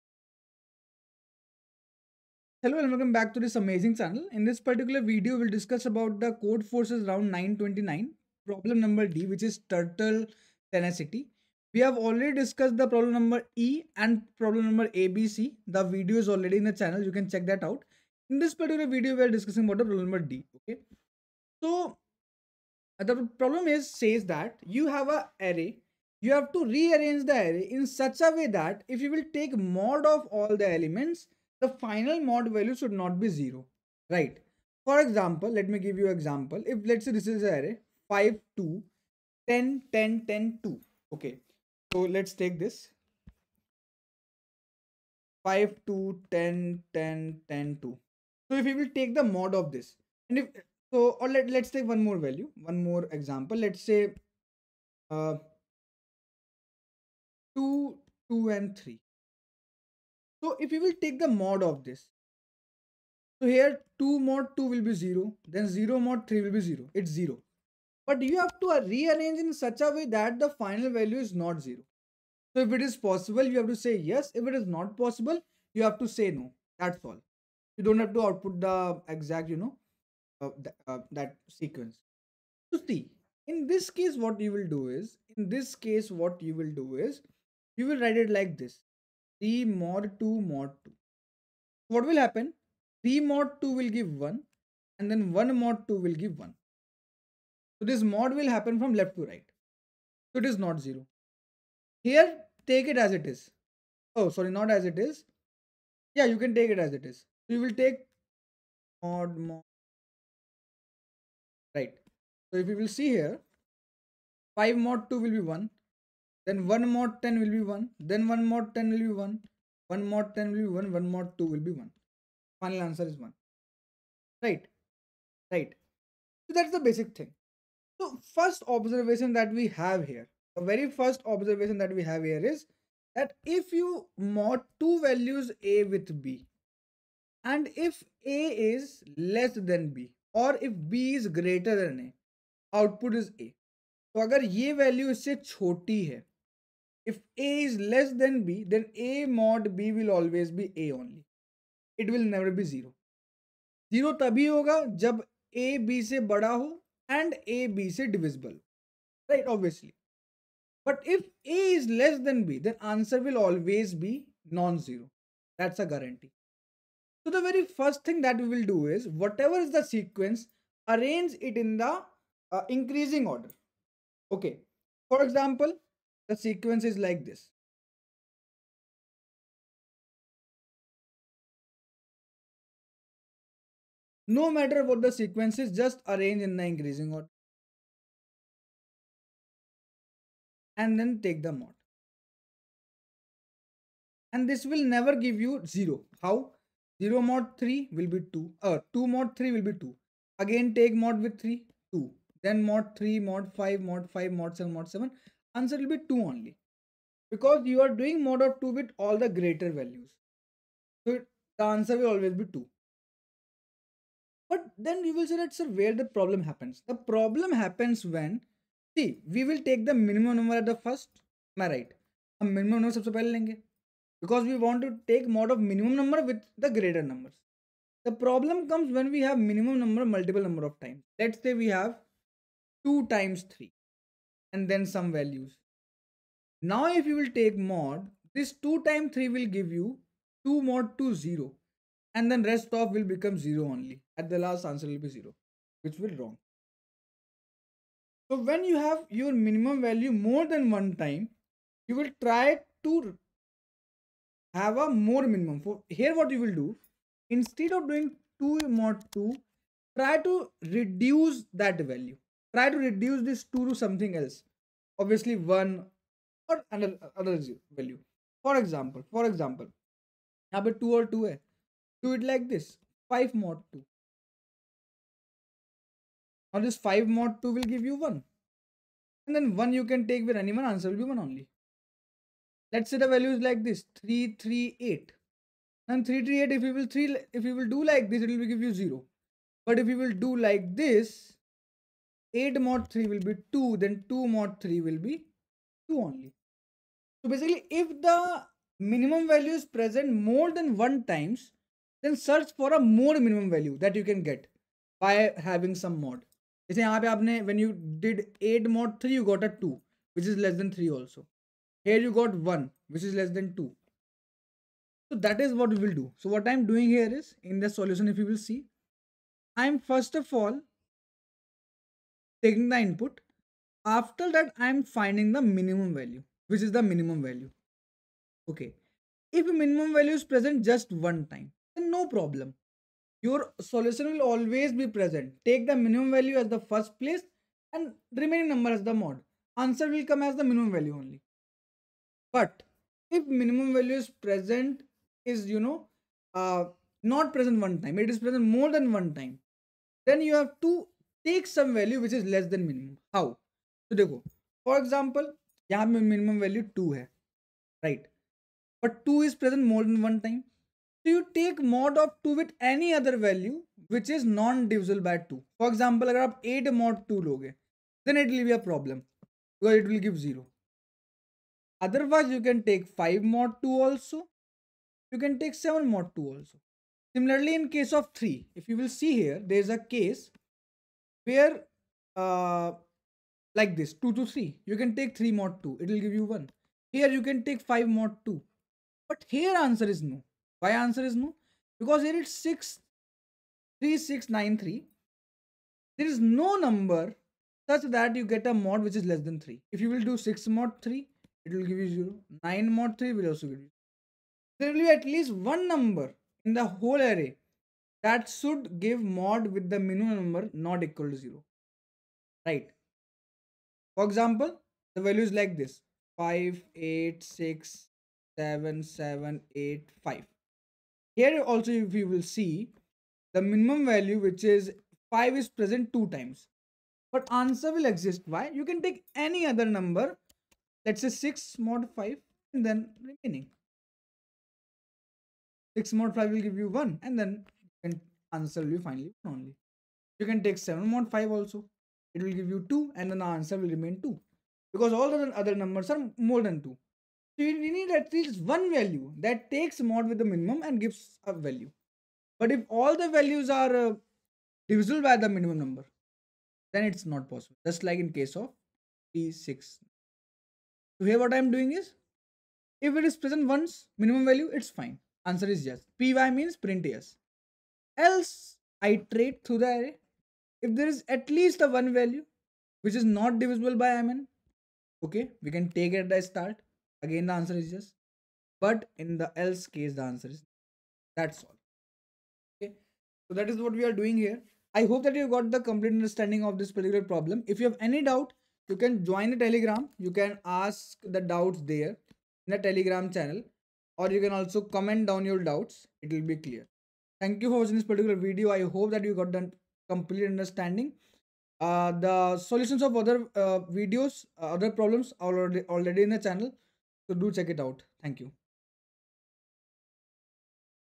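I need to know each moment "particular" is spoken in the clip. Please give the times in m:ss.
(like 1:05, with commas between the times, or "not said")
0:04, 0:18, 8:06, 8:17.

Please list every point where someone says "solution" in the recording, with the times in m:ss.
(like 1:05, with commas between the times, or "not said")
5:17, 5:33, 8:22.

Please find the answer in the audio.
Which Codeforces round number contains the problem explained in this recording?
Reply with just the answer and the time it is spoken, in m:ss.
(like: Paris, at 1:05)
929, at 0:07.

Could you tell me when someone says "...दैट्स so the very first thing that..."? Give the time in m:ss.
2:45.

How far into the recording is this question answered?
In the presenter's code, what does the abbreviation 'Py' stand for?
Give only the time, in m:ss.
7:46.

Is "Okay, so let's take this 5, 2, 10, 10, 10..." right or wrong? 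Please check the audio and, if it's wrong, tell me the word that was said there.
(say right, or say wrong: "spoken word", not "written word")
right.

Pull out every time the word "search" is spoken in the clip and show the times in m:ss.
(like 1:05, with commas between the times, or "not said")
5:02.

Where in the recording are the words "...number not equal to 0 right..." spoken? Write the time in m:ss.
6:50.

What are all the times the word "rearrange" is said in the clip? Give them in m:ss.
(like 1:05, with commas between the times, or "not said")
0:26, 1:08.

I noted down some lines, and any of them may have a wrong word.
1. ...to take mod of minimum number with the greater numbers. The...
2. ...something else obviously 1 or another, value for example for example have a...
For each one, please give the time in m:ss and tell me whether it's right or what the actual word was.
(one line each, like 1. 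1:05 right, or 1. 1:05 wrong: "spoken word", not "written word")
1. 3:44 right
2. 4:23 right.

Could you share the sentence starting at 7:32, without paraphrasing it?
But if all the values are uh, divisible by the minimum number, then it's not possible.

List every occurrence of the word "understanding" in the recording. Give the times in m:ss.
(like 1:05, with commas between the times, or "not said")
8:05, 8:20.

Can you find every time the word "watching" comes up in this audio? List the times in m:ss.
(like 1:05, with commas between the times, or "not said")
8:17.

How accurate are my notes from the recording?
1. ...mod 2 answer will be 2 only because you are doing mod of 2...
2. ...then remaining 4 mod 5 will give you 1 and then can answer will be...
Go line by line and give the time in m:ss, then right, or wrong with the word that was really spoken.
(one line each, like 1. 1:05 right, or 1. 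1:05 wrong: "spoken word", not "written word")
1. 3:24 wrong: "7", not "2"
2. 7:12 wrong: "6", not "4".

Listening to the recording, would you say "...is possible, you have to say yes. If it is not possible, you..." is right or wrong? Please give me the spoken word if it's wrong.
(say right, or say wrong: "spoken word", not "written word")
right.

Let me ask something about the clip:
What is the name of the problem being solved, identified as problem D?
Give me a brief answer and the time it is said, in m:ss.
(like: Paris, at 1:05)
Turtle Tenacity, at 0:09.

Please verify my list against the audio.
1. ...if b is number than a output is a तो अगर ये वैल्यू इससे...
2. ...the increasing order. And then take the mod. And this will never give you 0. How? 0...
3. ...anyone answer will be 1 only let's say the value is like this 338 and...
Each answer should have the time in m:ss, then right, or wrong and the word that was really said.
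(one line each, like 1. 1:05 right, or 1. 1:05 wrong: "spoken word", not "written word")
1. 2:20 wrong: "greater", not "number"
2. 3:06 right
3. 4:40 right.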